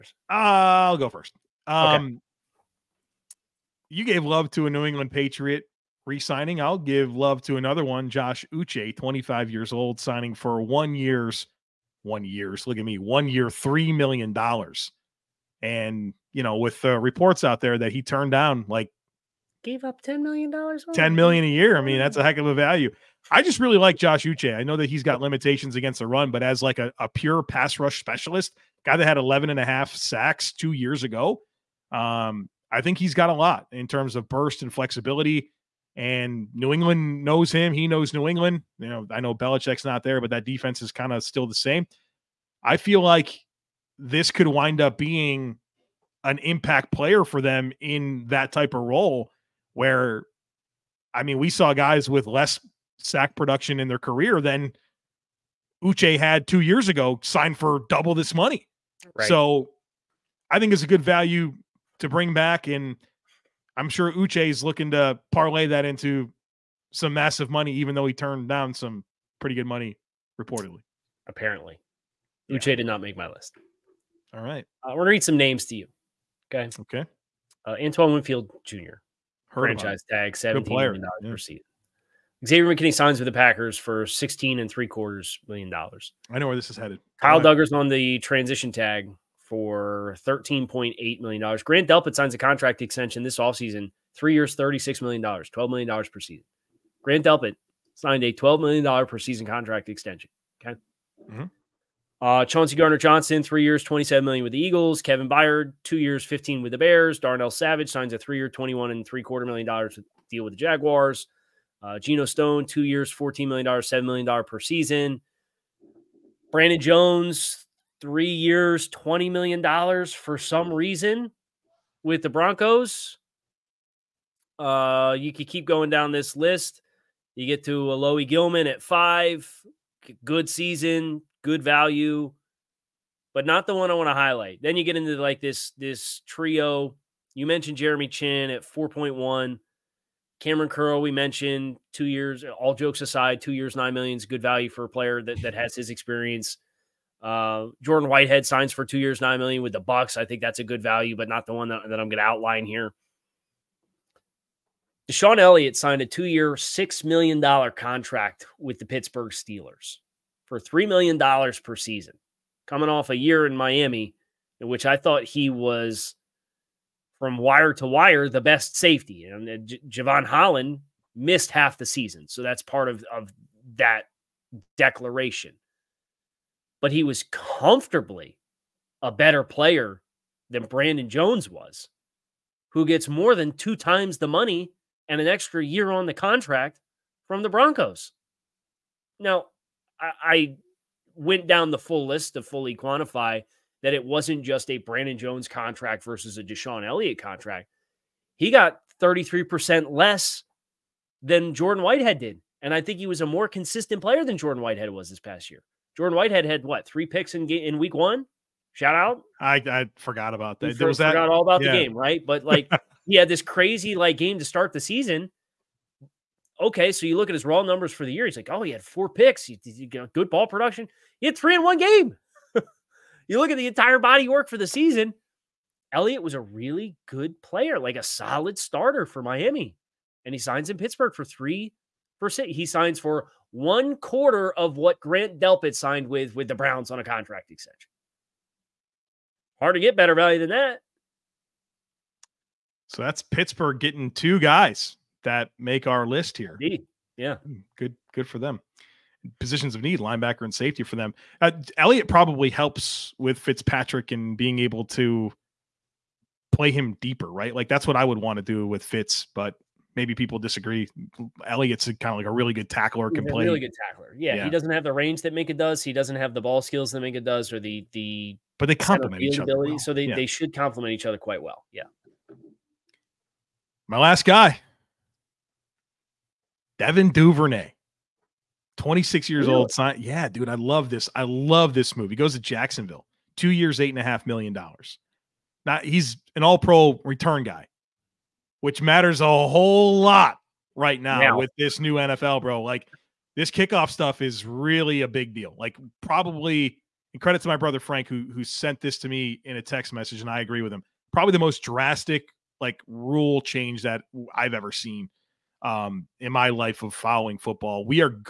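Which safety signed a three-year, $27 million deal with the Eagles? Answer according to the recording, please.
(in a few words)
Chauncey Gardner-Johnson.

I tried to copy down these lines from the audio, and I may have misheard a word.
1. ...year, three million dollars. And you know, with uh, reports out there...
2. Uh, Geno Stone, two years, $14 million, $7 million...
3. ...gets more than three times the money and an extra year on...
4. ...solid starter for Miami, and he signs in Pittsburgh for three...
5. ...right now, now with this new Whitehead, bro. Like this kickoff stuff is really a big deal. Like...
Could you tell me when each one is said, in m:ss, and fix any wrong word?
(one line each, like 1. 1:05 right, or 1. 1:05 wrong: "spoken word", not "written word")
1. 0:13 right
2. 1:51 right
3. 3:02 wrong: "two", not "three"
4. 3:48 right
5. 4:50 wrong: "NFL", not "Whitehead".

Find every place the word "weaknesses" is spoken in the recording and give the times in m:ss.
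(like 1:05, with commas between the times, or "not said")
not said.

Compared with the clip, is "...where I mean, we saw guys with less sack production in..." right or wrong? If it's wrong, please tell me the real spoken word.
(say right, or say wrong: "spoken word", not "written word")
right.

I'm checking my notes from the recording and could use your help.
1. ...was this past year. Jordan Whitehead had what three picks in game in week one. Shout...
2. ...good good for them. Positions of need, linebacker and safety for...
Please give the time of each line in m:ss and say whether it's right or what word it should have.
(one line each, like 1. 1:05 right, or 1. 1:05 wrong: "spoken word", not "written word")
1. 3:24 right
2. 4:07 right.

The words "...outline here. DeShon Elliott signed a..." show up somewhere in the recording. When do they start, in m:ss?
2:32.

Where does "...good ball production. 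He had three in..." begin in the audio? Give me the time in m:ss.
3:40.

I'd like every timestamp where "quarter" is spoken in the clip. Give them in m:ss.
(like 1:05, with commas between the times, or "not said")
1:24, 1:49, 3:53.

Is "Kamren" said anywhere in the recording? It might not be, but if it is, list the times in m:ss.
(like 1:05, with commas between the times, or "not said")
2:20.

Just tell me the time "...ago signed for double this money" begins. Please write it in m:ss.
0:56.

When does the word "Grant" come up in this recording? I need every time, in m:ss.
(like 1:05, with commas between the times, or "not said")
1:31, 1:37, 3:54.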